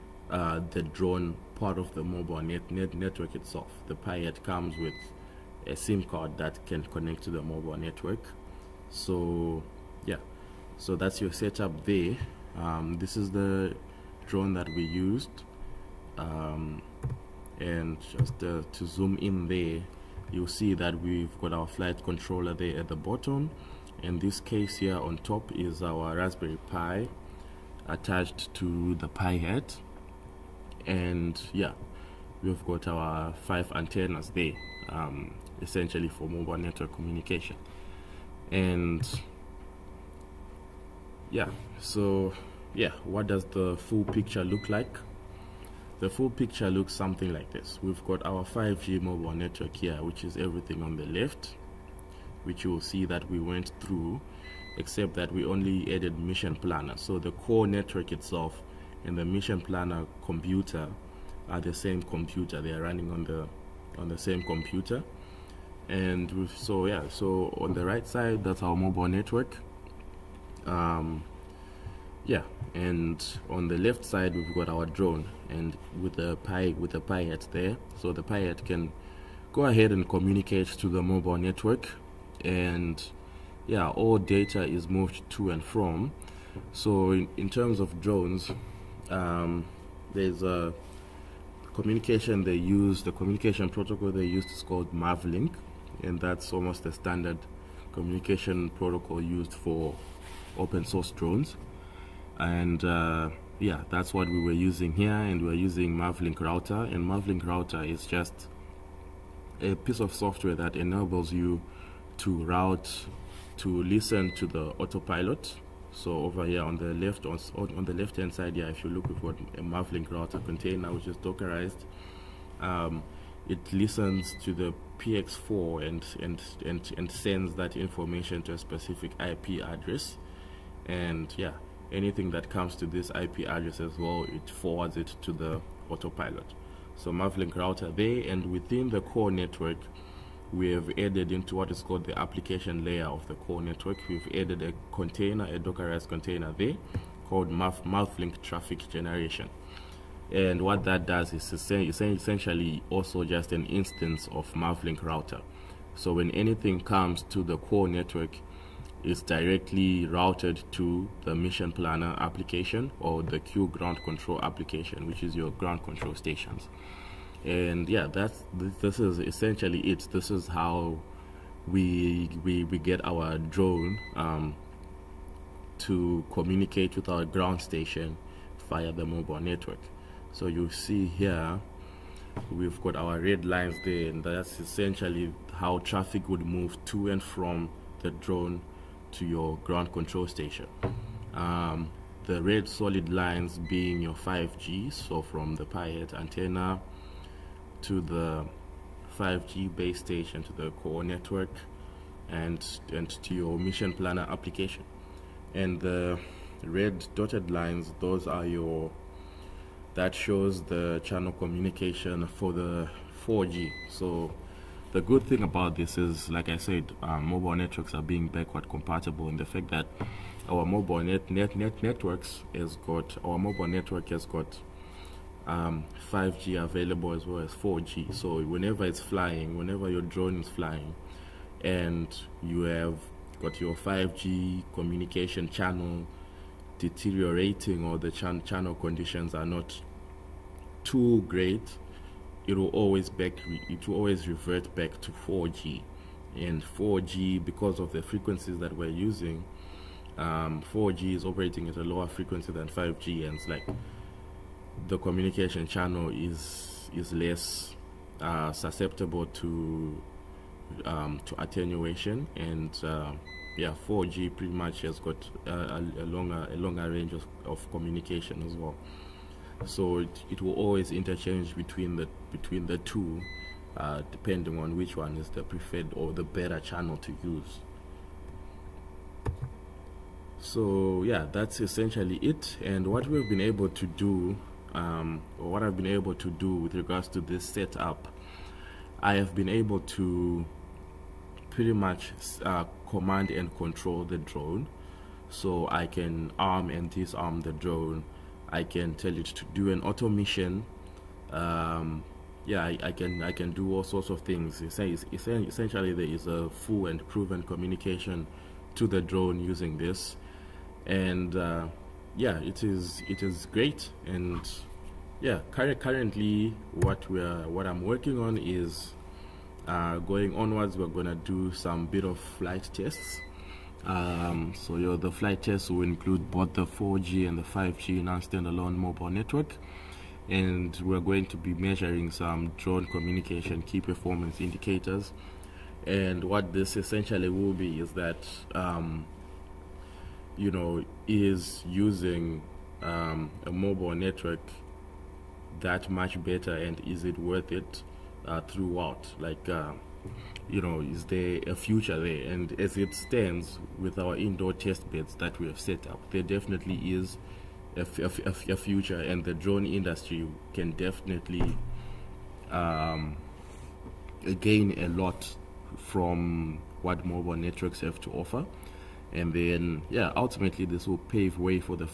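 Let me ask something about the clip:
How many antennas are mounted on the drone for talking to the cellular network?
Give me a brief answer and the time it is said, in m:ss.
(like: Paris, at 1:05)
5, at 0:33.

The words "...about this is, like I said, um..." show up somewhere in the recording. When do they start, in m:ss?
3:35.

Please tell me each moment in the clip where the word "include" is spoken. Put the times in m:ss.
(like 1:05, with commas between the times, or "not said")
5:25.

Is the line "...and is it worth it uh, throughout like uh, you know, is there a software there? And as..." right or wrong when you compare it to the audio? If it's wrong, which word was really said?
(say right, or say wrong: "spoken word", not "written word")
wrong: "future", not "software".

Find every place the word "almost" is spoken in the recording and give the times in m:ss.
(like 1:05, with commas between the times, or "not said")
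1:36.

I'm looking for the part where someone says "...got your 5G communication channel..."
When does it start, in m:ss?
3:53.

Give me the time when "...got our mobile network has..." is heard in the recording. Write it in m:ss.
3:42.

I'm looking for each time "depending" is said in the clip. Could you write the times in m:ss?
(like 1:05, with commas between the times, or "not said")
4:34.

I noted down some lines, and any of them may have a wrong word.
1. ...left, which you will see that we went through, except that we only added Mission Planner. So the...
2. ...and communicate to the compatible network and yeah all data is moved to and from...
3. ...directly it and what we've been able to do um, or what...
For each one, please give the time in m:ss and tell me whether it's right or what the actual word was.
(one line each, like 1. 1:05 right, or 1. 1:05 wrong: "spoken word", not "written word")
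1. 0:51 right
2. 1:19 wrong: "mobile", not "compatible"
3. 4:41 wrong: "essentially", not "directly".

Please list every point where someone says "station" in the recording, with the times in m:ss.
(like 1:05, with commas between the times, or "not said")
2:46, 2:57, 3:10, 3:19.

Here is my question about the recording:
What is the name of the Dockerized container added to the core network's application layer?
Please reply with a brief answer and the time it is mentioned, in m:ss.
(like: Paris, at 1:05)
Mavlink Traffic Generation, at 2:27.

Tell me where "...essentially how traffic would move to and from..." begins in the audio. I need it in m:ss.
3:04.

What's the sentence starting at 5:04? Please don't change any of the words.
Essentially, there is a full and proven communication to the drone using this, and uh, yeah, it is it is great.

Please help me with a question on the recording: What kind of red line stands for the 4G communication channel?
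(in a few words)
dotted lines.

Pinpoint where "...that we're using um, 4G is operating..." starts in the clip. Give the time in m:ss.
4:08.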